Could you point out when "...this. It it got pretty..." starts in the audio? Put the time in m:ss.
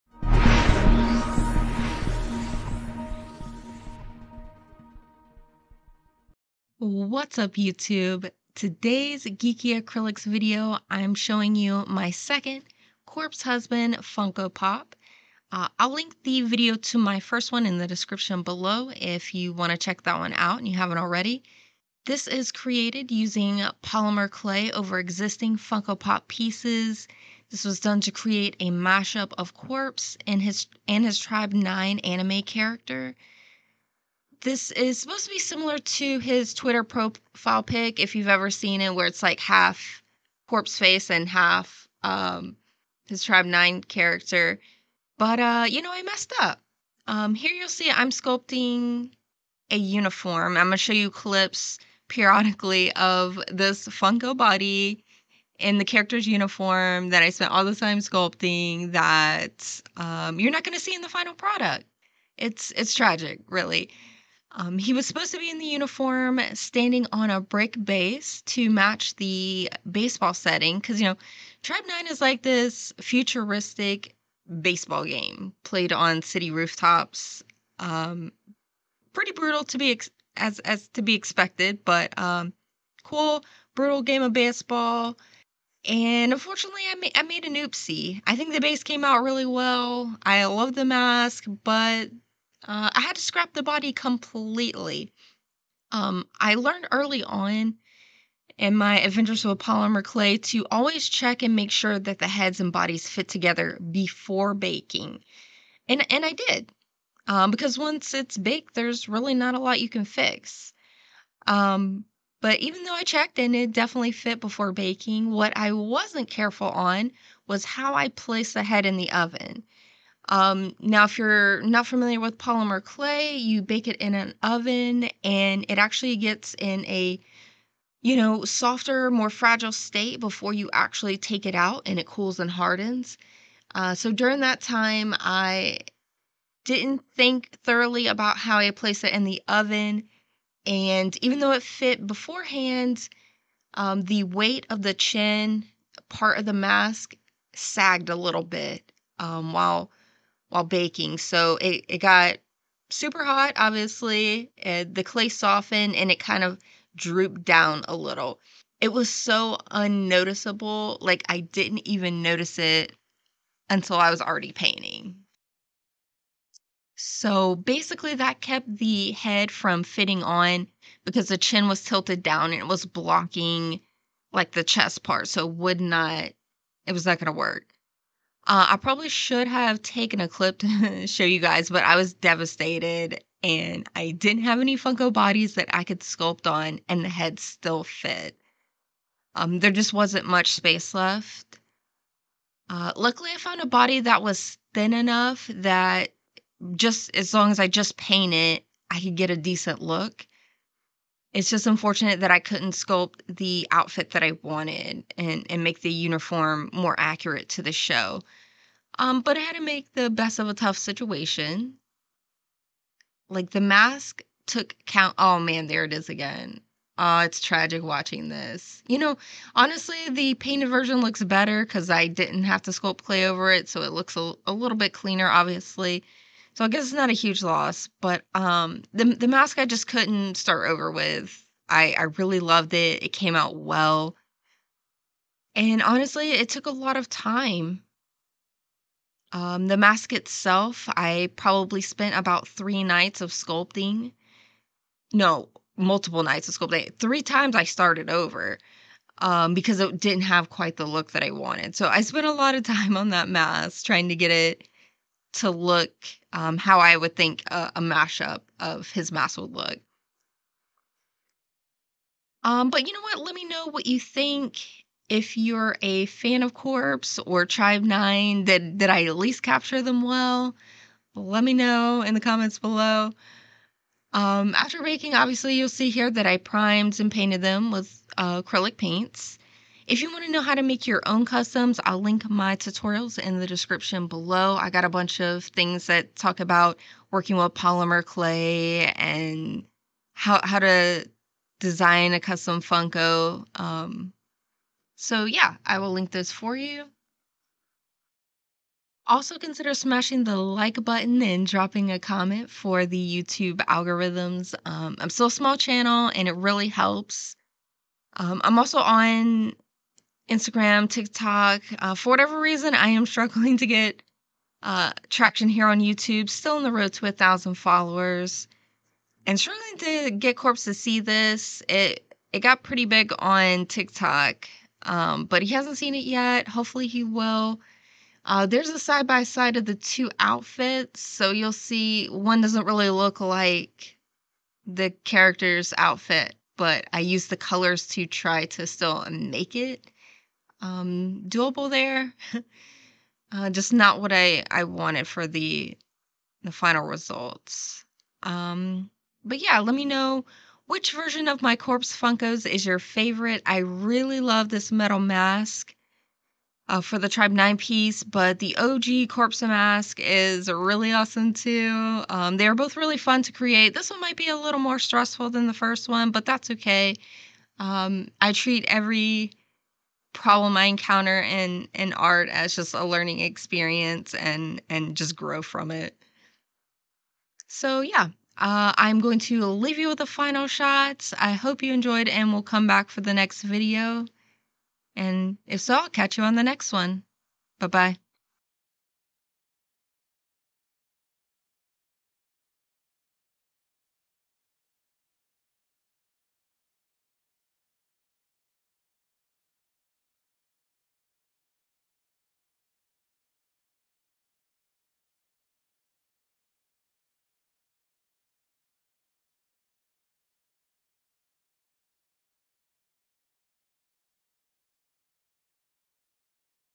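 5:20.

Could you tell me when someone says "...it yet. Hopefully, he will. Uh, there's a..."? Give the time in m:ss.
5:25.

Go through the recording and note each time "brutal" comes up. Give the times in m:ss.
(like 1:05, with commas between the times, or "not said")
1:19, 1:23.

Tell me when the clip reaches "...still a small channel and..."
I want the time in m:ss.
5:05.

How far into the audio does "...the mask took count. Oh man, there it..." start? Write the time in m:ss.
3:33.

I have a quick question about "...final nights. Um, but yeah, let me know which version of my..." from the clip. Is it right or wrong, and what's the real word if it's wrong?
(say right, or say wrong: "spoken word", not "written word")
wrong: "results", not "nights".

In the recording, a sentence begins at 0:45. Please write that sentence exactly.
But uh, you know, I messed up.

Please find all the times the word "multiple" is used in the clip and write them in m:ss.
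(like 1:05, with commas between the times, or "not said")
4:05.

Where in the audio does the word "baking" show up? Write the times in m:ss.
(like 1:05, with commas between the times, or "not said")
1:44, 1:54, 2:30, 4:34.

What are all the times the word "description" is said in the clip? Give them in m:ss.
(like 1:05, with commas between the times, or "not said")
0:17, 4:43.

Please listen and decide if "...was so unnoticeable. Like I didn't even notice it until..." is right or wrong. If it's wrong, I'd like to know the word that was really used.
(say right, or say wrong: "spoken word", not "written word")
right.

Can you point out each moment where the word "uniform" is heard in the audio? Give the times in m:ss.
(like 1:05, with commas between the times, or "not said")
0:49, 0:56, 1:05, 3:25.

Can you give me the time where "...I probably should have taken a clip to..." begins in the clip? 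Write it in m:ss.
2:58.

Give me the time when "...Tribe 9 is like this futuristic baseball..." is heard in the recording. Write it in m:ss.
1:11.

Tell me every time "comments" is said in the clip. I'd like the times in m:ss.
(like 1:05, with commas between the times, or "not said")
4:32, 5:01.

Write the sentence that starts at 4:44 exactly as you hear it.
I got a bunch of things that talk about working with polymer clay and how, how to design a custom Funko.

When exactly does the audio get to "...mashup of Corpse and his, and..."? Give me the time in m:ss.
0:28.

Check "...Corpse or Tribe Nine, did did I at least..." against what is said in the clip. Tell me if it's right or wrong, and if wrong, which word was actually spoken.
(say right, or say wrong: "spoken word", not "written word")
right.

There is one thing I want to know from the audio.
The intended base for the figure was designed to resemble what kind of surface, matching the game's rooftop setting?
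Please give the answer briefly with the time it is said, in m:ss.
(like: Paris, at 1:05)
Brick, at 1:07.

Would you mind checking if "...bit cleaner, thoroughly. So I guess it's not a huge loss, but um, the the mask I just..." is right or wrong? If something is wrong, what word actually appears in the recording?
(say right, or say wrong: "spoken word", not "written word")
wrong: "obviously", not "thoroughly".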